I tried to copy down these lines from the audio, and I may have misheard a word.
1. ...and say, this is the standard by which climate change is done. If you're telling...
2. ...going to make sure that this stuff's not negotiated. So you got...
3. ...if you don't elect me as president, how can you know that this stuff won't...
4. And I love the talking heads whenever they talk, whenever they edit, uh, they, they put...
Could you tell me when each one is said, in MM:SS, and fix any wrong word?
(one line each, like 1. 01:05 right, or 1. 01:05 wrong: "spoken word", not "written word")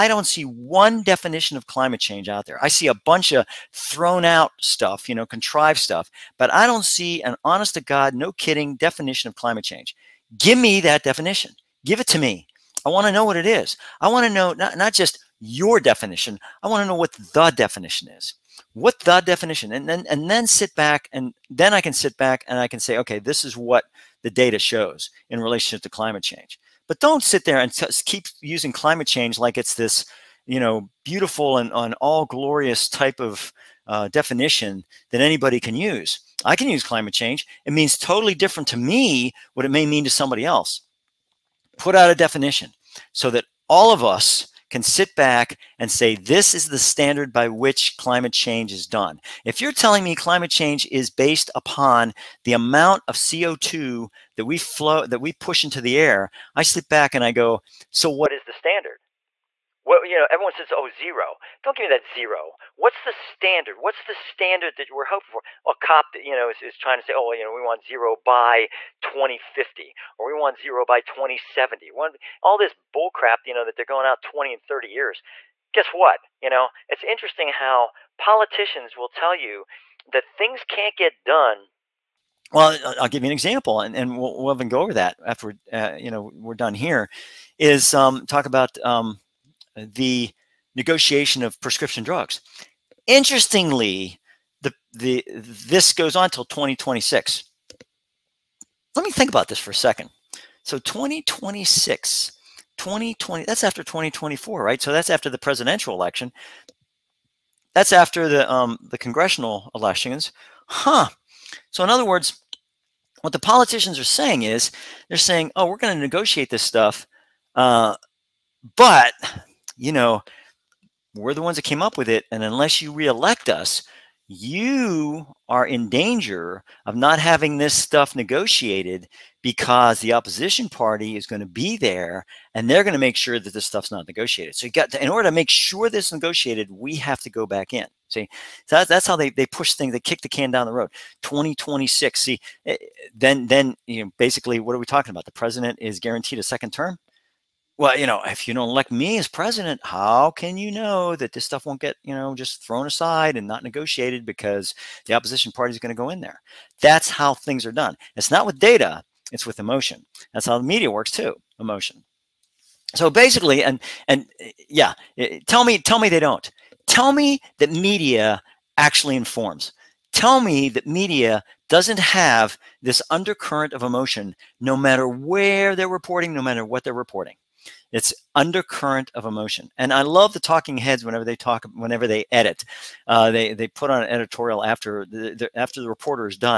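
1. 00:45 right
2. 02:12 right
3. 02:28 right
4. 02:59 right.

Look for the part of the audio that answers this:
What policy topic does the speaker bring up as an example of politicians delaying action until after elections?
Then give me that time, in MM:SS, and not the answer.
01:31.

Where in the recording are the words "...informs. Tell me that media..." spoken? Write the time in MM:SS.
02:49.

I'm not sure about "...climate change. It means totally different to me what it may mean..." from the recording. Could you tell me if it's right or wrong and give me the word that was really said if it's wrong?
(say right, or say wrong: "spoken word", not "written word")
right.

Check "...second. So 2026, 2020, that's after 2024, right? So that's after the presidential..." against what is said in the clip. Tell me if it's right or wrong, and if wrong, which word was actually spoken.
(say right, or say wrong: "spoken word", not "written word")
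right.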